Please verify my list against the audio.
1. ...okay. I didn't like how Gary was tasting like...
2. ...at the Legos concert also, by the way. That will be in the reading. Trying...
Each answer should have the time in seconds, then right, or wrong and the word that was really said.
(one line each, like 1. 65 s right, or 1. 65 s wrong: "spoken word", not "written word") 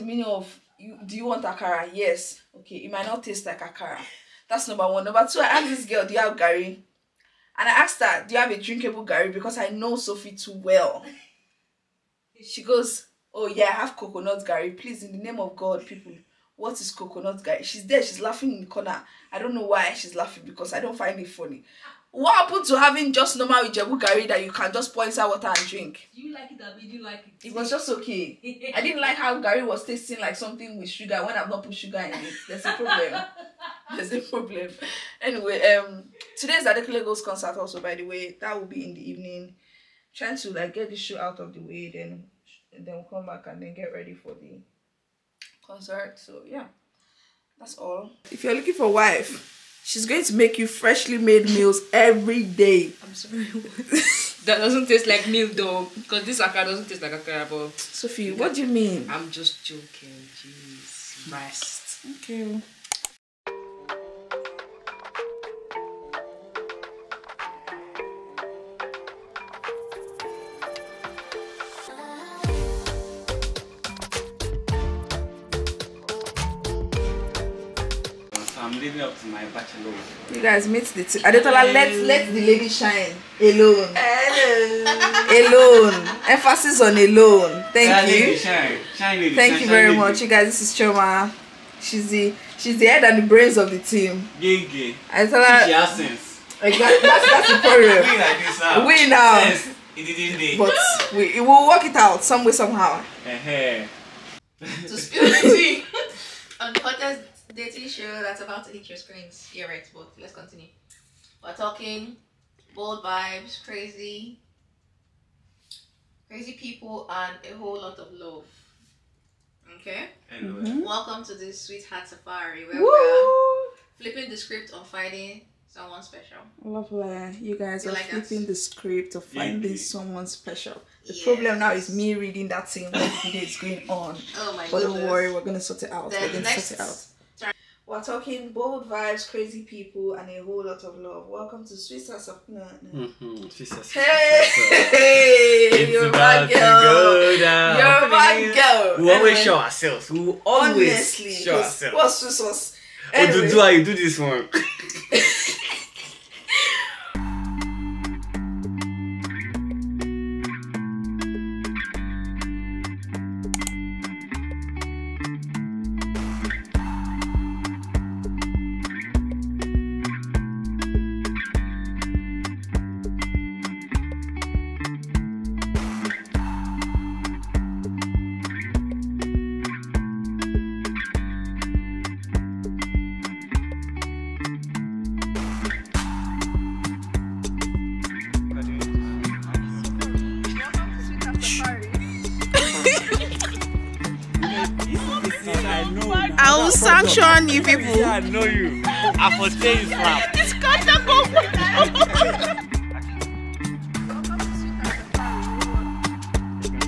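1. 27 s right
2. 36 s wrong: "evening", not "reading".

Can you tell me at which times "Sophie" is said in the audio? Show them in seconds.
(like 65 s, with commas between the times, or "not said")
9 s, 57 s.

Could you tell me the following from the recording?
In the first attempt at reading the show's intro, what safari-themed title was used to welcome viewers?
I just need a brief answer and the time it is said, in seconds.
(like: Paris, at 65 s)
Sweetheart Safari, at 121 s.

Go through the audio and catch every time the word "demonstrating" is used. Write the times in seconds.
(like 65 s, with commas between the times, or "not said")
not said.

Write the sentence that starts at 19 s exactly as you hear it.
I don't know why she's laughing because I don't find it funny.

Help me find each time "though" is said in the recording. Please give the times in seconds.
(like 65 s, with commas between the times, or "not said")
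55 s.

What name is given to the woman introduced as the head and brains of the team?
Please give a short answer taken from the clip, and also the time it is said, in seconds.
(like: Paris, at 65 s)
Choma, at 90 s.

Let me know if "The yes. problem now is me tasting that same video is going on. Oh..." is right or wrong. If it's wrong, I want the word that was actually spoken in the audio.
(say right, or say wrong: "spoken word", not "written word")
wrong: "reading", not "tasting".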